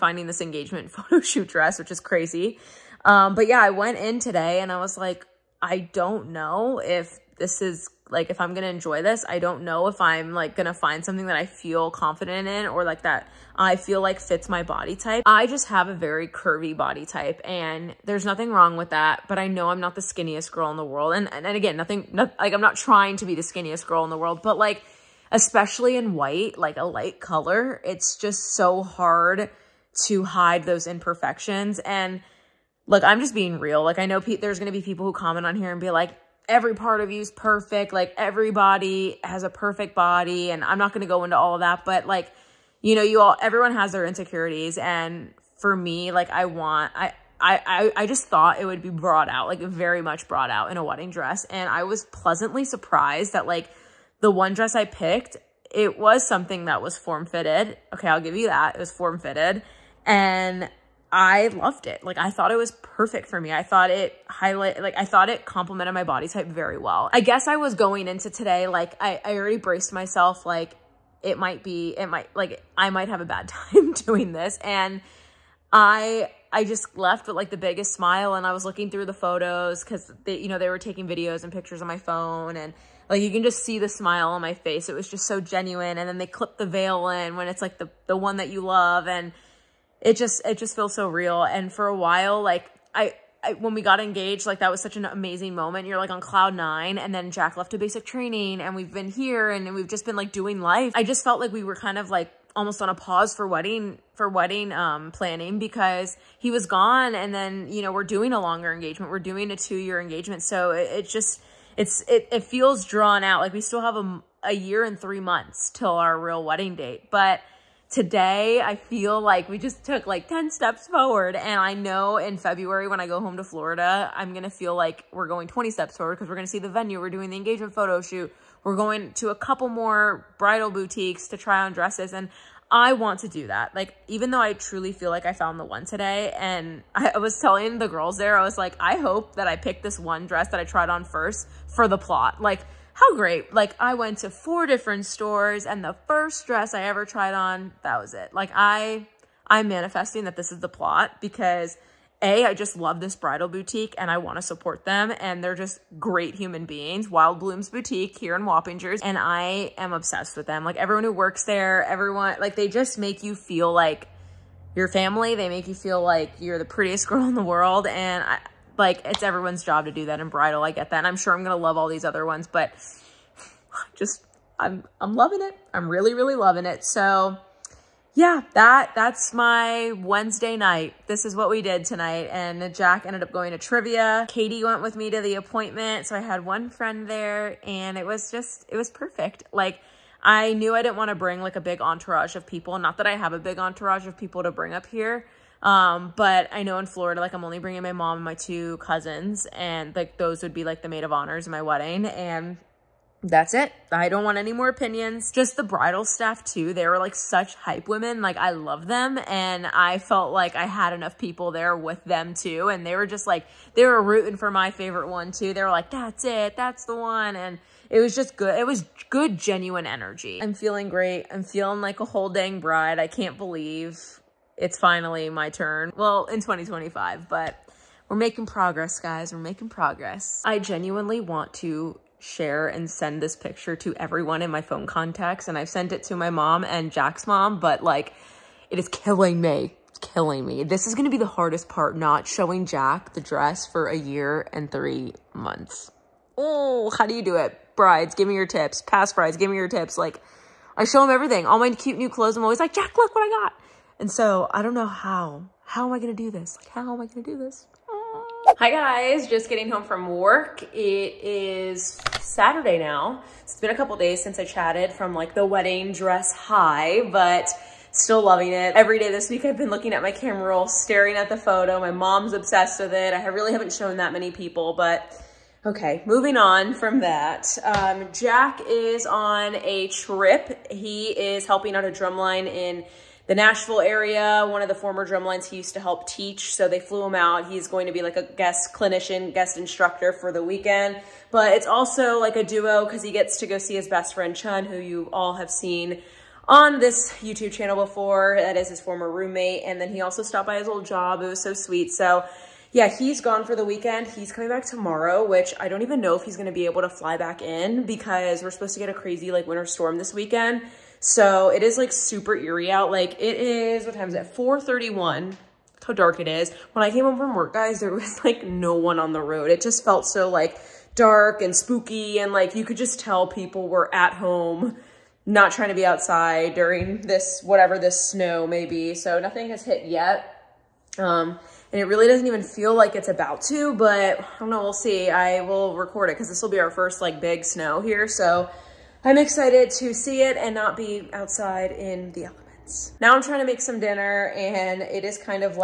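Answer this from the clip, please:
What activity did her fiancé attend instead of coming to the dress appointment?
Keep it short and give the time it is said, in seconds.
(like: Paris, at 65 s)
Trivia, at 183 s.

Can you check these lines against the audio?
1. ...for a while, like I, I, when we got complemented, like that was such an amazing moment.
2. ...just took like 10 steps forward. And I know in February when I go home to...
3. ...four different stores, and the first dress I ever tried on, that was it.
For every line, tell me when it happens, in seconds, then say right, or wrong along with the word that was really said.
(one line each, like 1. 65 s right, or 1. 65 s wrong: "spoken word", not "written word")
1. 91 s wrong: "engaged", not "complemented"
2. 119 s right
3. 144 s right.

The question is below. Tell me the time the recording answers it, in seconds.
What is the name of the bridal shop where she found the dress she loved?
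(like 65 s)
157 s.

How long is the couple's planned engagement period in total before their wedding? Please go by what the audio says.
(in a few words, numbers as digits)
2 years.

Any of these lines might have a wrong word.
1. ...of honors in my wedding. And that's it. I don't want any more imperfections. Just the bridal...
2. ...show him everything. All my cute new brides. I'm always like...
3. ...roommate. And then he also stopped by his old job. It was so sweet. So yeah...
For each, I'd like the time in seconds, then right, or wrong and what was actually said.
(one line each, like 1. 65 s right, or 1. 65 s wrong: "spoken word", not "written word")
1. 201 s wrong: "opinions", not "imperfections"
2. 250 s wrong: "clothes", not "brides"
3. 299 s right.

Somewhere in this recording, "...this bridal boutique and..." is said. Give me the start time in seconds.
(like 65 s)
153 s.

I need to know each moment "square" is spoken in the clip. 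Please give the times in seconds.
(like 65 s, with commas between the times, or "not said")
not said.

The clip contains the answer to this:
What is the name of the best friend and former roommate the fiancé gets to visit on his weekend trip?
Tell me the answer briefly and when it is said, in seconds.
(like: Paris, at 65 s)
Chun, at 294 s.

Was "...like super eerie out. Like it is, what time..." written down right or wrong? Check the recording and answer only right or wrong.
right.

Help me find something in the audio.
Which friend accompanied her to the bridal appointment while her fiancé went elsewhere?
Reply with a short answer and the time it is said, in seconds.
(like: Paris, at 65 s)
Katie, at 184 s.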